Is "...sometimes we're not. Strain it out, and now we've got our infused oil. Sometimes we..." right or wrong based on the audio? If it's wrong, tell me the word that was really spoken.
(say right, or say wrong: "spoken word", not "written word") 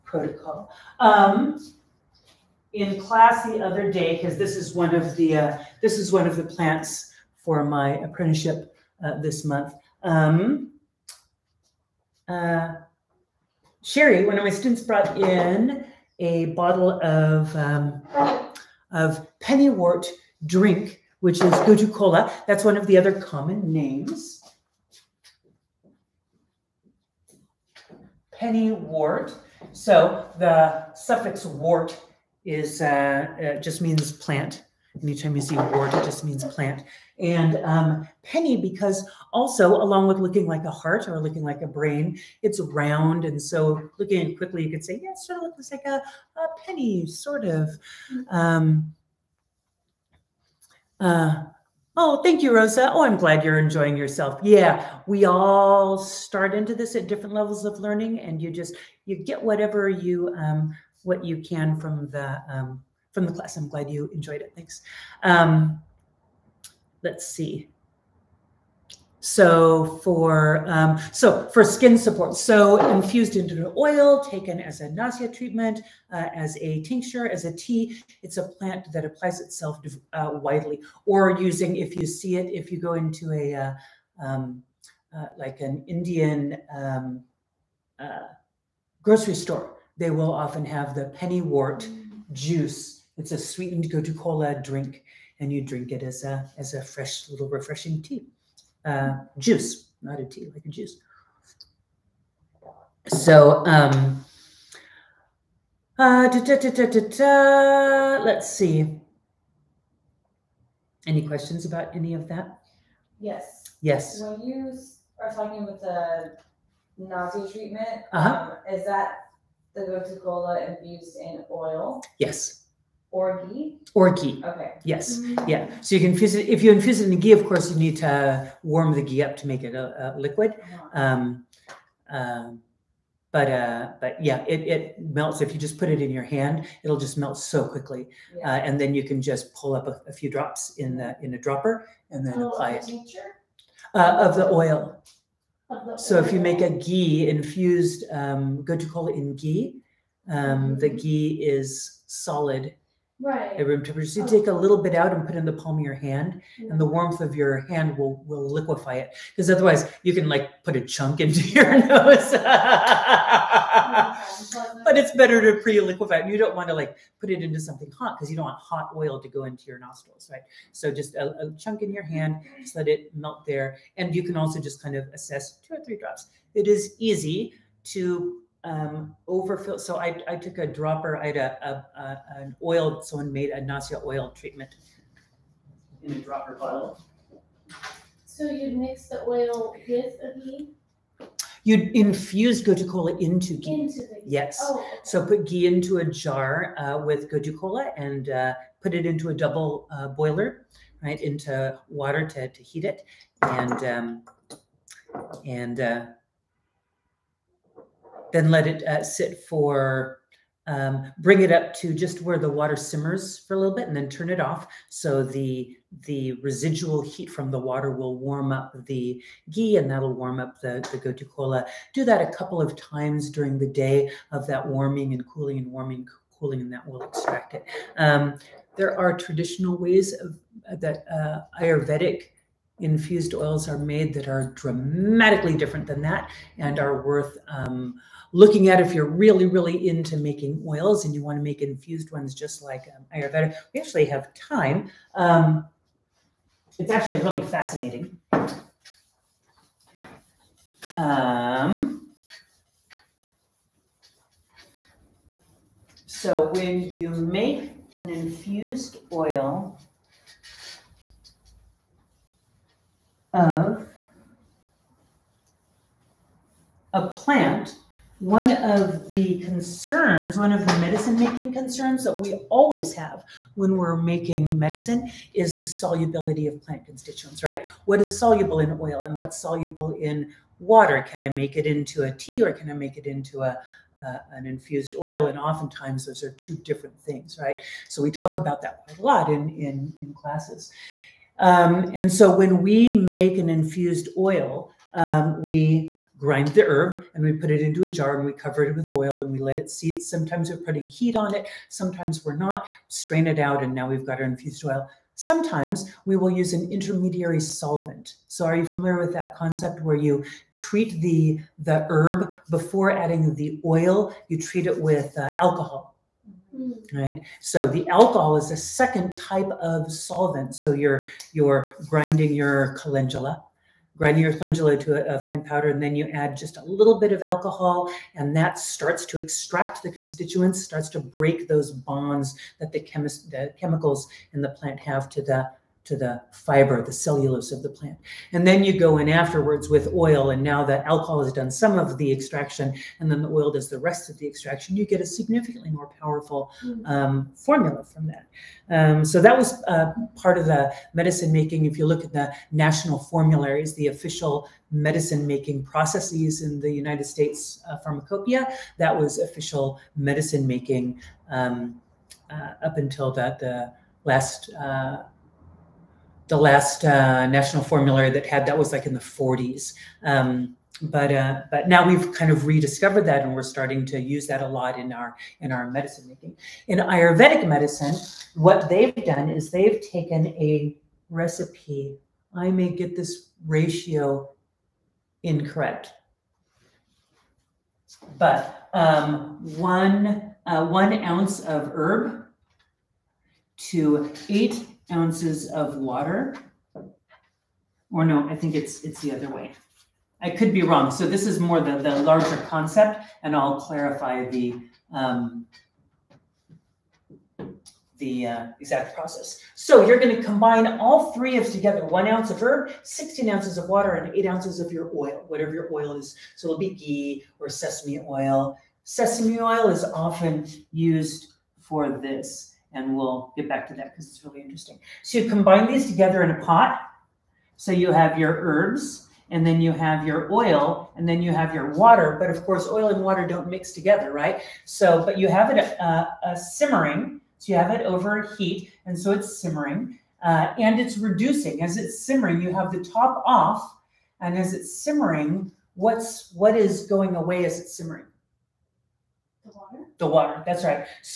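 right.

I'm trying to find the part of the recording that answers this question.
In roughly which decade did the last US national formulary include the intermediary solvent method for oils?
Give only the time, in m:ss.
6:08.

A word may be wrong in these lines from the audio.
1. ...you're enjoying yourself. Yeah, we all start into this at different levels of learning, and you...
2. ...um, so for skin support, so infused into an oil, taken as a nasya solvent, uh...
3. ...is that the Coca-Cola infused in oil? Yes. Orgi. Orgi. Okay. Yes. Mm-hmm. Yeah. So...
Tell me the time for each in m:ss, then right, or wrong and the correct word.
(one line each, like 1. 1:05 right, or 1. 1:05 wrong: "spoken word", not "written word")
1. 0:53 right
2. 1:10 wrong: "treatment", not "solvent"
3. 1:58 right.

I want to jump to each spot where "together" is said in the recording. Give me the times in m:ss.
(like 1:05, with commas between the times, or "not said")
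6:51, 7:05, 7:13.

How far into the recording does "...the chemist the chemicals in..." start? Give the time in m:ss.
5:32.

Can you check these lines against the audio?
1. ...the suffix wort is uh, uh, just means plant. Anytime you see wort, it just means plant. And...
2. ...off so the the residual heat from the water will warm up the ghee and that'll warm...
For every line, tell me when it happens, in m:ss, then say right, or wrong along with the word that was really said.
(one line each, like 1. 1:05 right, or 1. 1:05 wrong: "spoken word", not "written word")
1. 0:30 right
2. 3:34 right.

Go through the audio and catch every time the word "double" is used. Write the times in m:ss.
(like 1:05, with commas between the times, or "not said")
3:19.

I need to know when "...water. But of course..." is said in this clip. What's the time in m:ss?
7:11.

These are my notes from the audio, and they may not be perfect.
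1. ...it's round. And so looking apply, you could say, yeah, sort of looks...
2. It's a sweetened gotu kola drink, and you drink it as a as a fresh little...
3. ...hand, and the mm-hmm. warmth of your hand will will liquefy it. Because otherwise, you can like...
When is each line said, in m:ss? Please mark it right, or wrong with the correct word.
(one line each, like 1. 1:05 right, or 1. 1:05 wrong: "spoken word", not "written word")
1. 0:42 wrong: "quickly", not "apply"
2. 1:33 right
3. 2:35 right.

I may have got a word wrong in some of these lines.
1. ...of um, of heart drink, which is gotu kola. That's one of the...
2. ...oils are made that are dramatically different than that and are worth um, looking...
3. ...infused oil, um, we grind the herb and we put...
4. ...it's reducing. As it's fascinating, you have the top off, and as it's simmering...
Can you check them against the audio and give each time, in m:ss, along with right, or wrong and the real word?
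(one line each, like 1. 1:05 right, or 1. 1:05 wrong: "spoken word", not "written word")
1. 0:17 wrong: "pennywort", not "heart"
2. 3:53 right
3. 4:53 right
4. 7:20 wrong: "simmering", not "fascinating".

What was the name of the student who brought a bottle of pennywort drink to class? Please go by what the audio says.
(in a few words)
Sherry.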